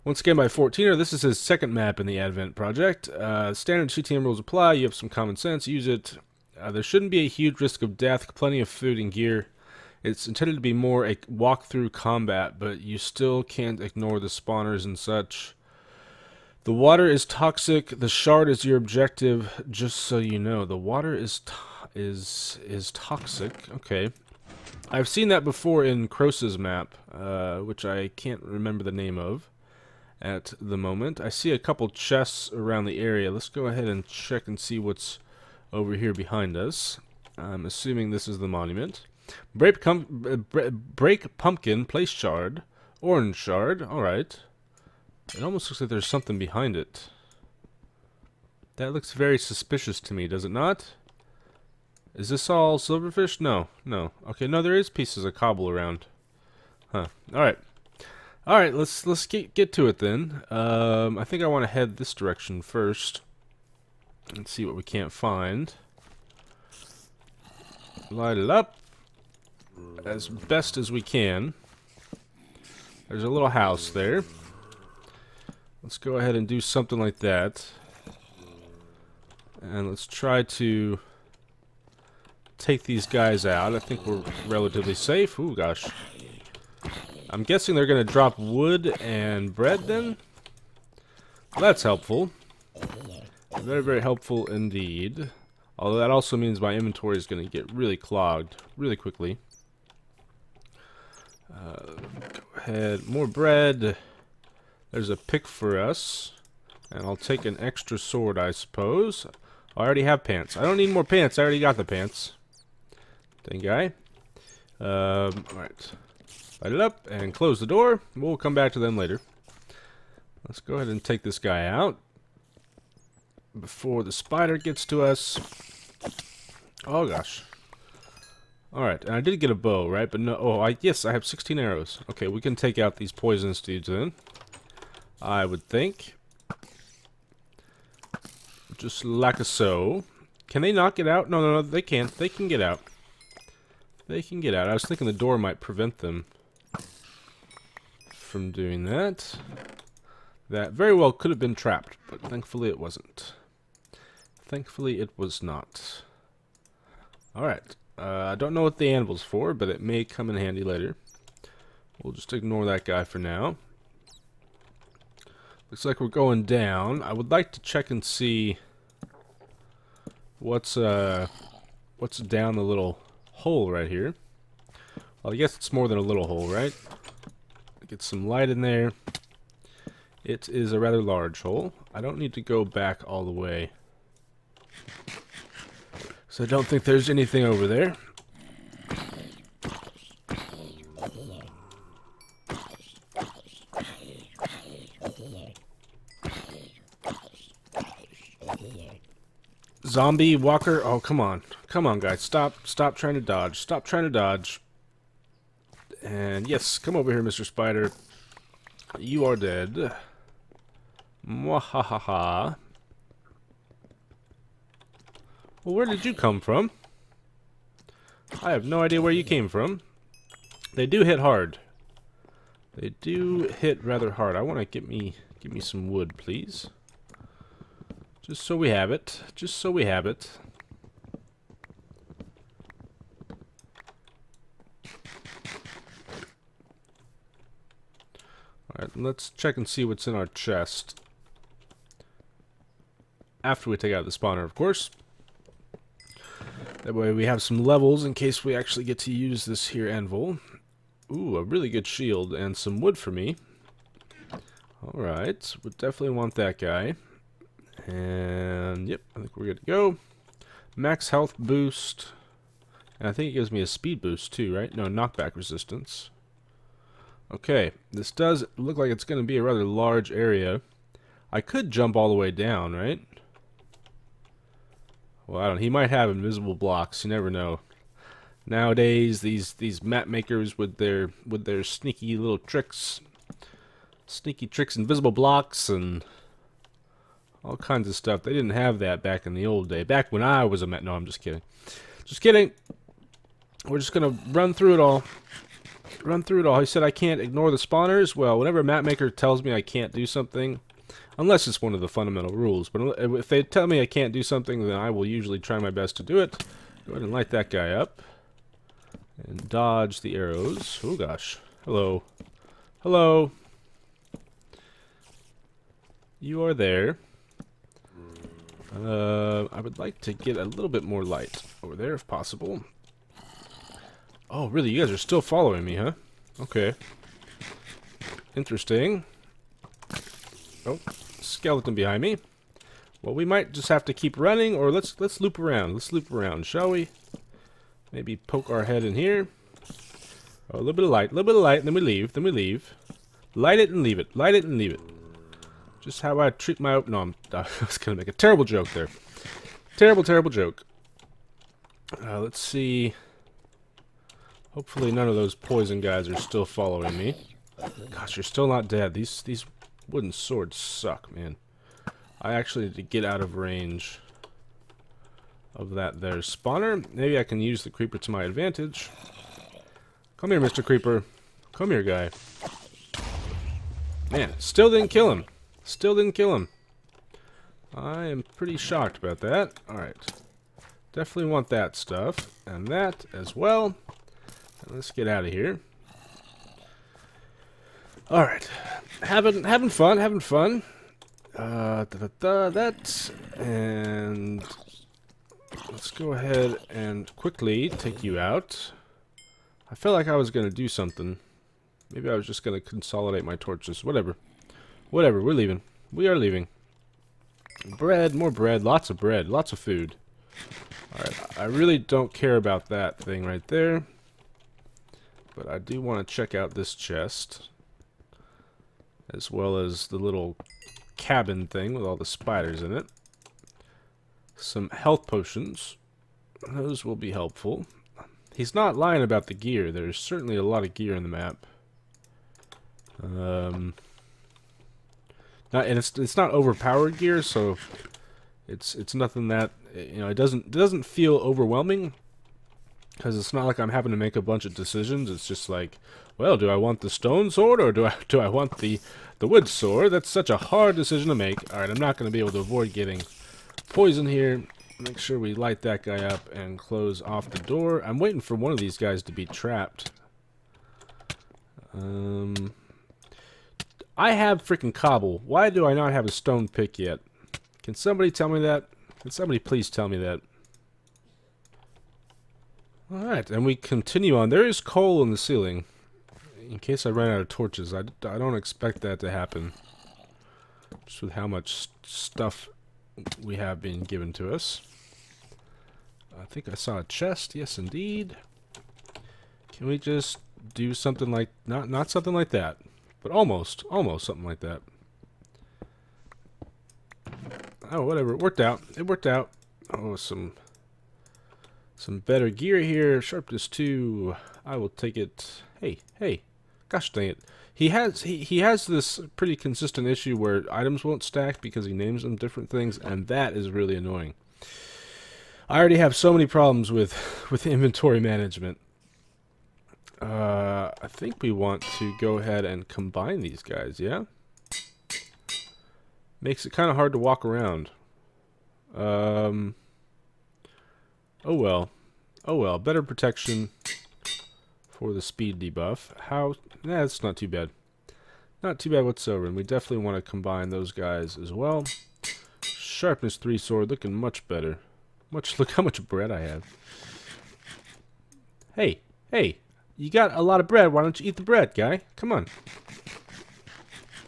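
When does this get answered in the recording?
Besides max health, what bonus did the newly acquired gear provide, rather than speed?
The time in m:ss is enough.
4:24.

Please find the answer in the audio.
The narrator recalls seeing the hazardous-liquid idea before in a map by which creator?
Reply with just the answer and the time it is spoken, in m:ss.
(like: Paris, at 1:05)
Crose, at 0:26.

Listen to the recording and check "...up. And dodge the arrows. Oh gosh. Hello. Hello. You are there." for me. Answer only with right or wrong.
right.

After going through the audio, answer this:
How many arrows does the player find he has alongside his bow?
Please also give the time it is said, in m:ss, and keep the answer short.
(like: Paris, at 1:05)
16, at 2:11.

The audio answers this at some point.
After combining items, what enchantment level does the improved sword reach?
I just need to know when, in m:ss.
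9:02.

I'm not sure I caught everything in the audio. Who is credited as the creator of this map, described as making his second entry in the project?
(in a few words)
14er.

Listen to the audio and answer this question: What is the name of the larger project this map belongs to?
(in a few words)
Advent.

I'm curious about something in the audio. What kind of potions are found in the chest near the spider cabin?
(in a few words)
Health potions.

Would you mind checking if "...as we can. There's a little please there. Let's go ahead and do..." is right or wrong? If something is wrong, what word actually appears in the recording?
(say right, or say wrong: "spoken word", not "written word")
wrong: "house", not "please".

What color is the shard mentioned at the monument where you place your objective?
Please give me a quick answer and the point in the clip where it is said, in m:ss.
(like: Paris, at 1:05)
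Orange, at 0:42.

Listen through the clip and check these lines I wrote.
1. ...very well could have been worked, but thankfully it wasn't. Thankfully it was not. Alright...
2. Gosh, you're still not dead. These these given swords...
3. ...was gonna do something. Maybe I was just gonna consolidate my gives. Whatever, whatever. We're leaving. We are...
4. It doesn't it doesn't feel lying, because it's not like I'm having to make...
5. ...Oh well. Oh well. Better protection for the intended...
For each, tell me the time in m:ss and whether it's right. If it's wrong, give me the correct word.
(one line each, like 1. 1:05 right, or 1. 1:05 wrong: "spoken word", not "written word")
1. 2:30 wrong: "trapped", not "worked"
2. 5:57 wrong: "wooden", not "given"
3. 6:40 wrong: "torches", not "gives"
4. 7:20 wrong: "overwhelming", not "lying"
5. 8:51 wrong: "speed", not "intended".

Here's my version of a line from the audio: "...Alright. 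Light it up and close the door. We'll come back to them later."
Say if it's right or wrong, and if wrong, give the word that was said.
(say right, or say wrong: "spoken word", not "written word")
right.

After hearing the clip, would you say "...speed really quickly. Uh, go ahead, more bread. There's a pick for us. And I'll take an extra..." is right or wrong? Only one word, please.
wrong.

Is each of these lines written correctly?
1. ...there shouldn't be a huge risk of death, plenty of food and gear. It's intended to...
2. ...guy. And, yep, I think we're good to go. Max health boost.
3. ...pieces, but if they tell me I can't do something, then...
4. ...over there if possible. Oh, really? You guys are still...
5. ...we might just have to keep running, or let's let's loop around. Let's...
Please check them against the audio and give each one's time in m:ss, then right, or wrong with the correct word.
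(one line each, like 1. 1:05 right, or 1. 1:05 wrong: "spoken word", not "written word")
1. 0:06 right
2. 4:16 right
3. 5:02 wrong: "rules", not "pieces"
4. 5:21 right
5. 5:33 right.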